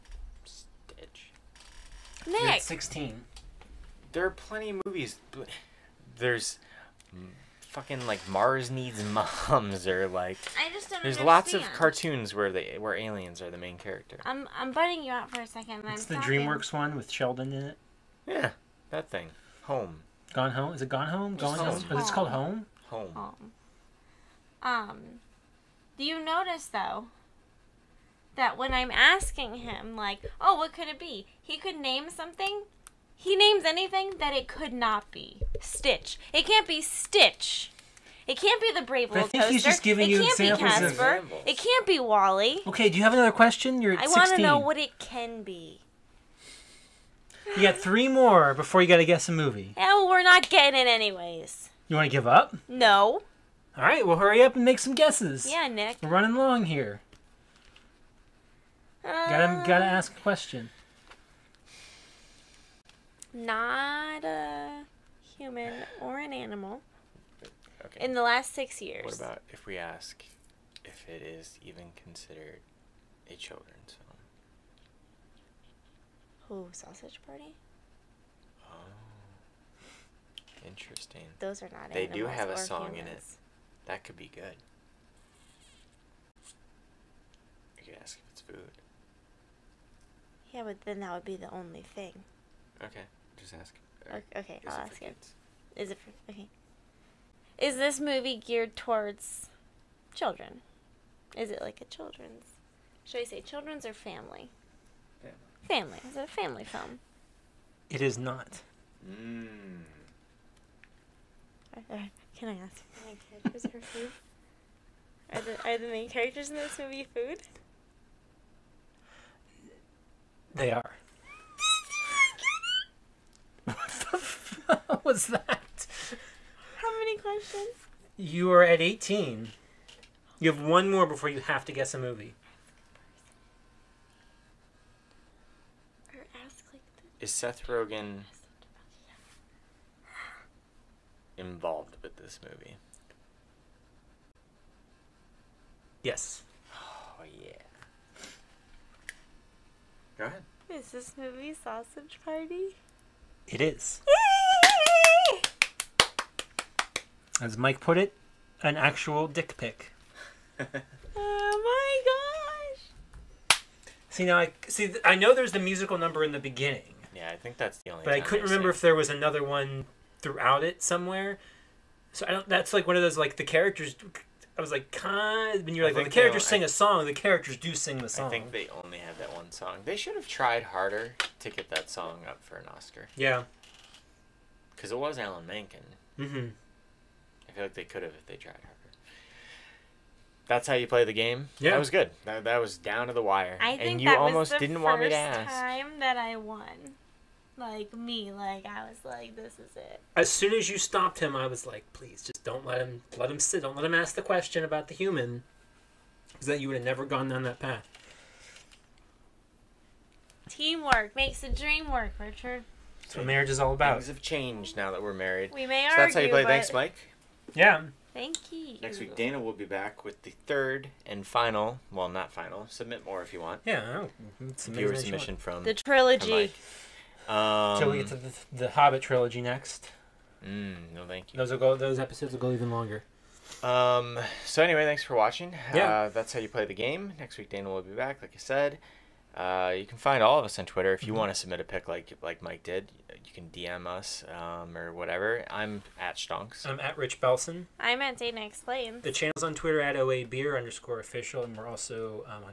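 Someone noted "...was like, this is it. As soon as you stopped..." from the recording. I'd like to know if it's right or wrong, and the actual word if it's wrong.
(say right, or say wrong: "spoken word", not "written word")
right.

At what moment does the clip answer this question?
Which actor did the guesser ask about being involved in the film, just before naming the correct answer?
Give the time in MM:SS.
02:17.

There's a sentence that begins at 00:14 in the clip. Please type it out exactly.
I'm I'm butting you out for a second.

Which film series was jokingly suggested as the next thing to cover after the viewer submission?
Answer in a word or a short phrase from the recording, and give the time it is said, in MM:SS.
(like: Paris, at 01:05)
The Hobbit trilogy, at 03:48.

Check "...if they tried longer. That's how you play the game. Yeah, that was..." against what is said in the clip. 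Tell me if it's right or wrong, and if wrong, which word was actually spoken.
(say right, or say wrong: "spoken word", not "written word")
wrong: "harder", not "longer".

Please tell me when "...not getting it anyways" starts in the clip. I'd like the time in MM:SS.
00:50.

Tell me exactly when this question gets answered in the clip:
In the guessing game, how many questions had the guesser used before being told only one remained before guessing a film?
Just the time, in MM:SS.
02:08.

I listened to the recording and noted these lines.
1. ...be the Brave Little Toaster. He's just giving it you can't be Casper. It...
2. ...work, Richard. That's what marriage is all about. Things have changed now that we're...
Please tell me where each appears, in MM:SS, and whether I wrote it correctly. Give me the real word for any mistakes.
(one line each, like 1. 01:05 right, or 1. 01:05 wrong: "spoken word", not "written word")
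1. 00:38 right
2. 03:31 right.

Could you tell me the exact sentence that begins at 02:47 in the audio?
Yeah, I think that's the only.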